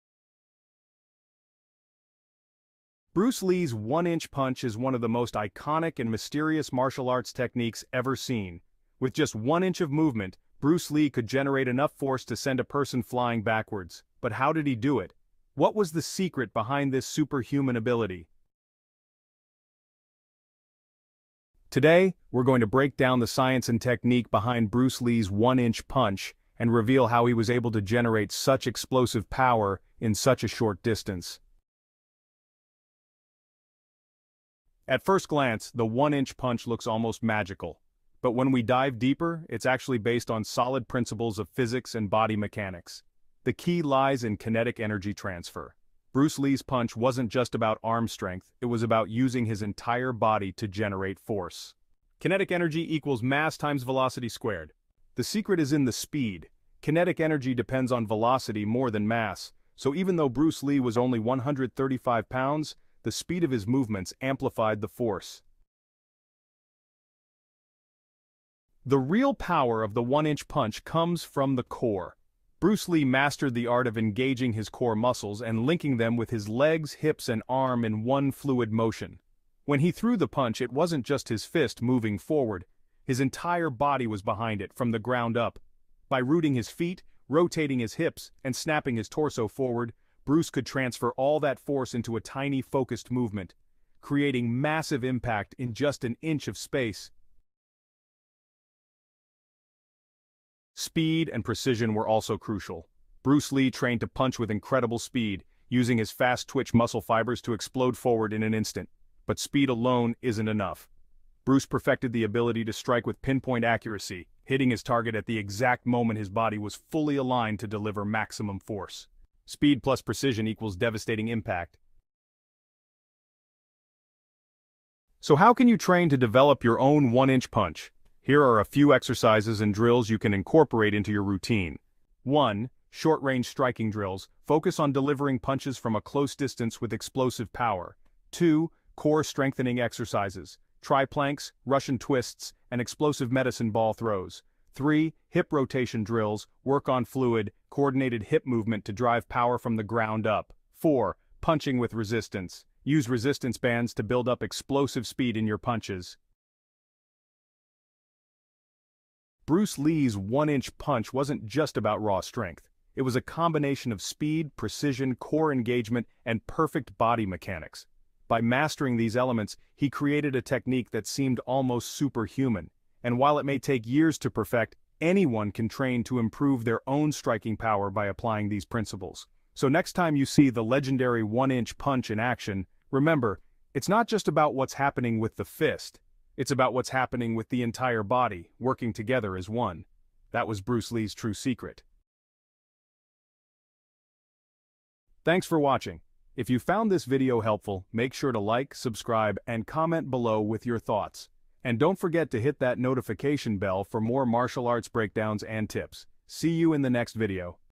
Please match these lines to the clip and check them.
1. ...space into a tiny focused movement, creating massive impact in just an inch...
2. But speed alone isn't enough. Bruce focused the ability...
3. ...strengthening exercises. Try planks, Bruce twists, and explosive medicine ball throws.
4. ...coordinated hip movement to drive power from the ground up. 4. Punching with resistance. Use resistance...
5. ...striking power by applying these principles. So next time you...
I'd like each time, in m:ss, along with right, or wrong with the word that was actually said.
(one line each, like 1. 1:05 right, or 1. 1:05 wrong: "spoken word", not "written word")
1. 1:31 wrong: "force", not "space"
2. 1:49 wrong: "perfected", not "focused"
3. 2:19 wrong: "Russian", not "Bruce"
4. 2:27 right
5. 2:57 right.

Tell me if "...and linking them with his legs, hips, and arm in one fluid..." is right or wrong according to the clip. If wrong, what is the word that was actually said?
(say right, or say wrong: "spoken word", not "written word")
right.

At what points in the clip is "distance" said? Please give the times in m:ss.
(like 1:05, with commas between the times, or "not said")
0:30, 2:16.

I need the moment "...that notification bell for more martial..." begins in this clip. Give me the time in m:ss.
3:22.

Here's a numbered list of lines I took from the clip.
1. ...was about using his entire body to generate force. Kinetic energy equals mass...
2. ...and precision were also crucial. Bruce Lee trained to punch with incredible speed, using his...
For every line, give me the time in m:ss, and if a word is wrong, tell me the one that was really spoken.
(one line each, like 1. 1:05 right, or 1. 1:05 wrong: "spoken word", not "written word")
1. 0:48 right
2. 1:41 right.